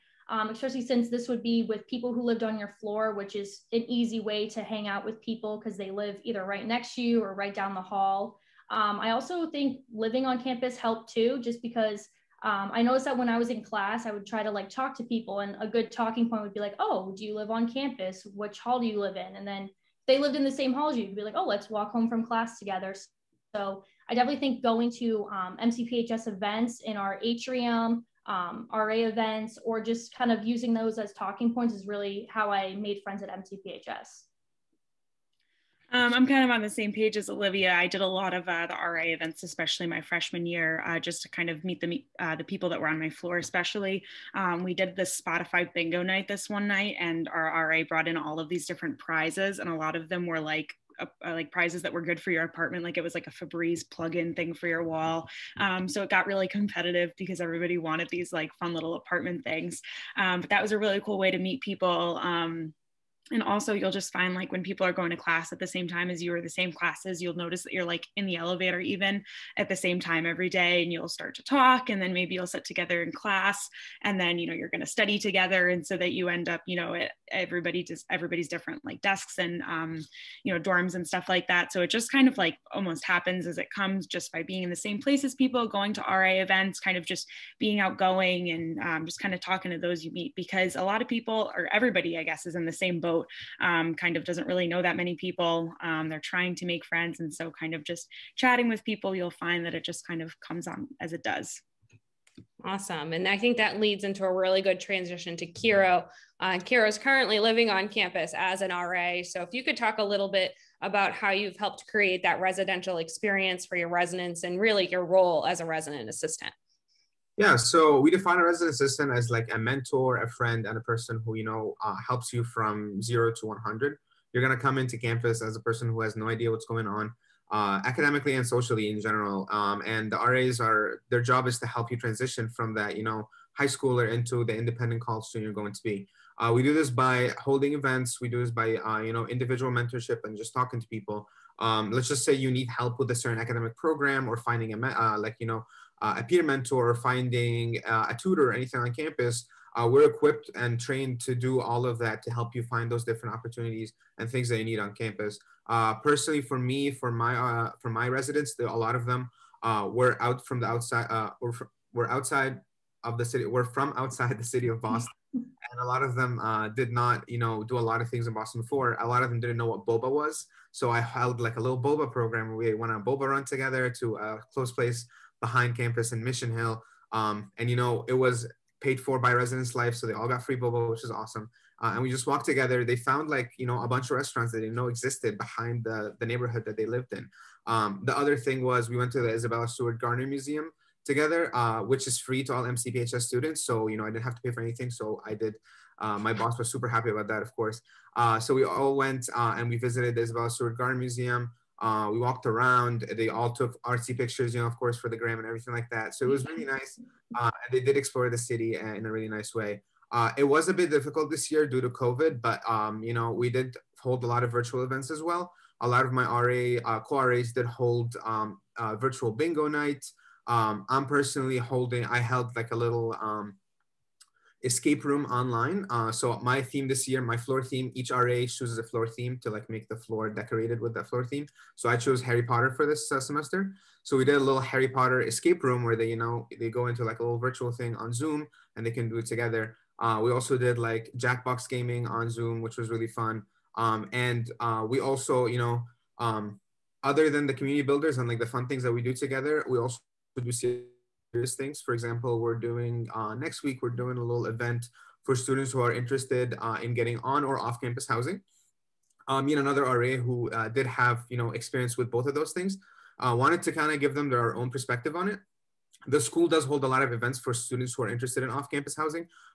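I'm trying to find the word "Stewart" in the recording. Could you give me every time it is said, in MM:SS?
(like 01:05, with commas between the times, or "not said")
03:09, 03:20.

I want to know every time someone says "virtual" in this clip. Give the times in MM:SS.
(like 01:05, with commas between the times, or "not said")
03:34, 03:38, 03:57.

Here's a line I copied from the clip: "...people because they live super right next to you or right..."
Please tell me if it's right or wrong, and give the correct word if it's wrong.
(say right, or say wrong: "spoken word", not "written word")
wrong: "either", not "super".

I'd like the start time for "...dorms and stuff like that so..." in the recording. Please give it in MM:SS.
01:20.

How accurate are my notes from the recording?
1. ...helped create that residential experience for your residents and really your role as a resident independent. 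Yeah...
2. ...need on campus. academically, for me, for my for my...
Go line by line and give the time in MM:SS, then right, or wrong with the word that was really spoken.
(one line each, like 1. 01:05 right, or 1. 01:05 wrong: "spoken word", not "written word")
1. 01:51 wrong: "assistant", not "independent"
2. 02:34 wrong: "personally", not "academically".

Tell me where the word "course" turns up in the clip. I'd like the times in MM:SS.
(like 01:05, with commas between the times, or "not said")
03:17, 03:24.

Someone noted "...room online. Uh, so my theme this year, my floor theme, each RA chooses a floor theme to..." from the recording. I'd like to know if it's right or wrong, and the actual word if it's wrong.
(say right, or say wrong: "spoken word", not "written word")
right.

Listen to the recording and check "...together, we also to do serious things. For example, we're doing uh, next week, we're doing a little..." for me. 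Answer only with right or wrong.
right.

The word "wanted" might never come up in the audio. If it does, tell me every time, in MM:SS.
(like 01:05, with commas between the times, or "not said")
00:57, 04:23.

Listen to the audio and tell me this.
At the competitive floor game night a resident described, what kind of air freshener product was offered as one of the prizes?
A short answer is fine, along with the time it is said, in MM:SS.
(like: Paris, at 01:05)
Febreze plug-in, at 00:53.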